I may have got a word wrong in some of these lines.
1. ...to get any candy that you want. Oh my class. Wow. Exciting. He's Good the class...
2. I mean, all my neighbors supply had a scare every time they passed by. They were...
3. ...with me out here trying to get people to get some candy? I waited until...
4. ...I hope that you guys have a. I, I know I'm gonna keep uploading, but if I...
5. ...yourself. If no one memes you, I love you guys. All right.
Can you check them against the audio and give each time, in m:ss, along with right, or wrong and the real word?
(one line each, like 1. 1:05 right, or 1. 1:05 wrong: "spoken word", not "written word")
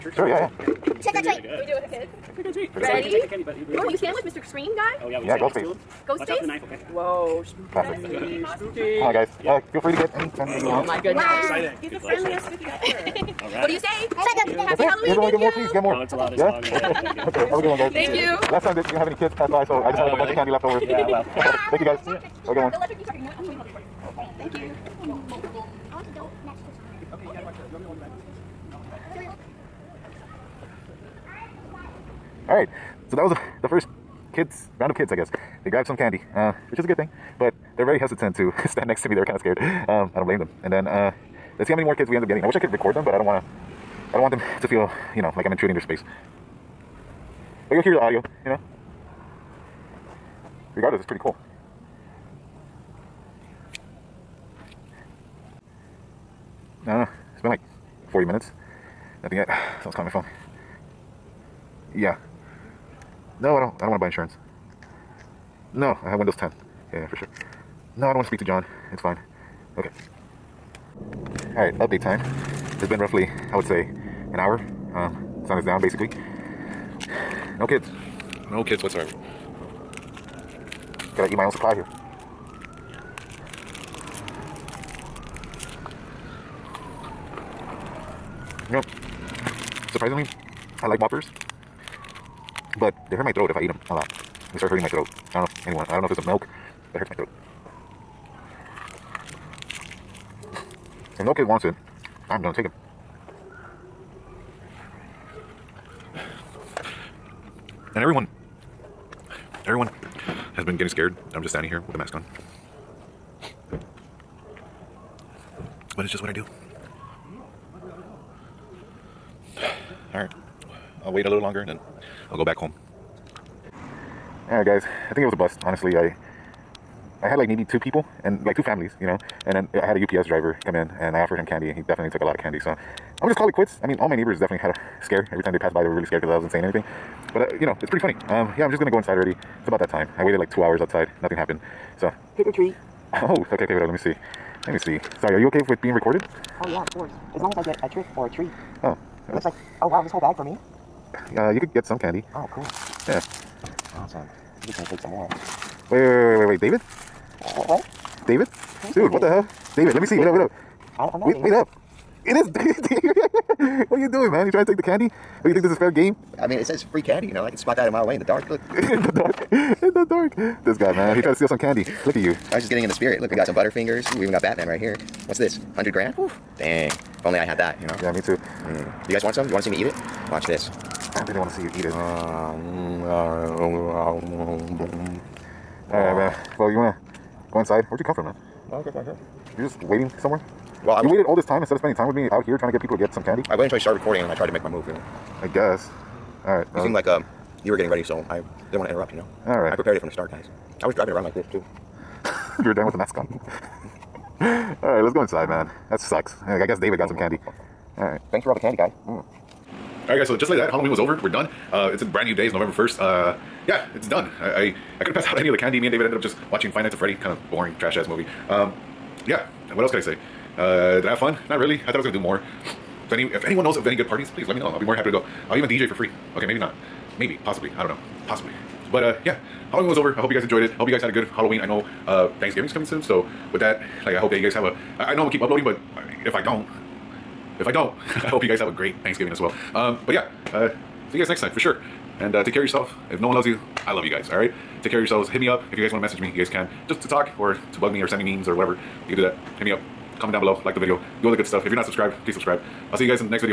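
1. 0:09 wrong: "goodness", not "class"
2. 2:13 wrong: "definitely", not "supply"
3. 3:12 right
4. 3:54 right
5. 4:02 wrong: "loves", not "memes".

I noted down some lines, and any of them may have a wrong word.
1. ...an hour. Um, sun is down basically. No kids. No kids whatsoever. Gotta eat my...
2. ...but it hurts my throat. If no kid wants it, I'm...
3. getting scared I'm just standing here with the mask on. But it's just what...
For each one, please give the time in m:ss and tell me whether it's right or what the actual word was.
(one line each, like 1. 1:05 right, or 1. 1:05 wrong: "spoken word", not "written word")
1. 1:13 right
2. 1:36 right
3. 1:50 right.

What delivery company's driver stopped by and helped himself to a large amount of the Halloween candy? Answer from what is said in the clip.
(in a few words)
UPS.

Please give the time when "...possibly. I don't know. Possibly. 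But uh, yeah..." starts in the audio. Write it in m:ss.
3:47.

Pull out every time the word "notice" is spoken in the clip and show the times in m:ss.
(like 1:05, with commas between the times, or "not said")
not said.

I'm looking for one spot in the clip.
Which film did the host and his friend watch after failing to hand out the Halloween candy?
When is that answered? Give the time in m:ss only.
3:36.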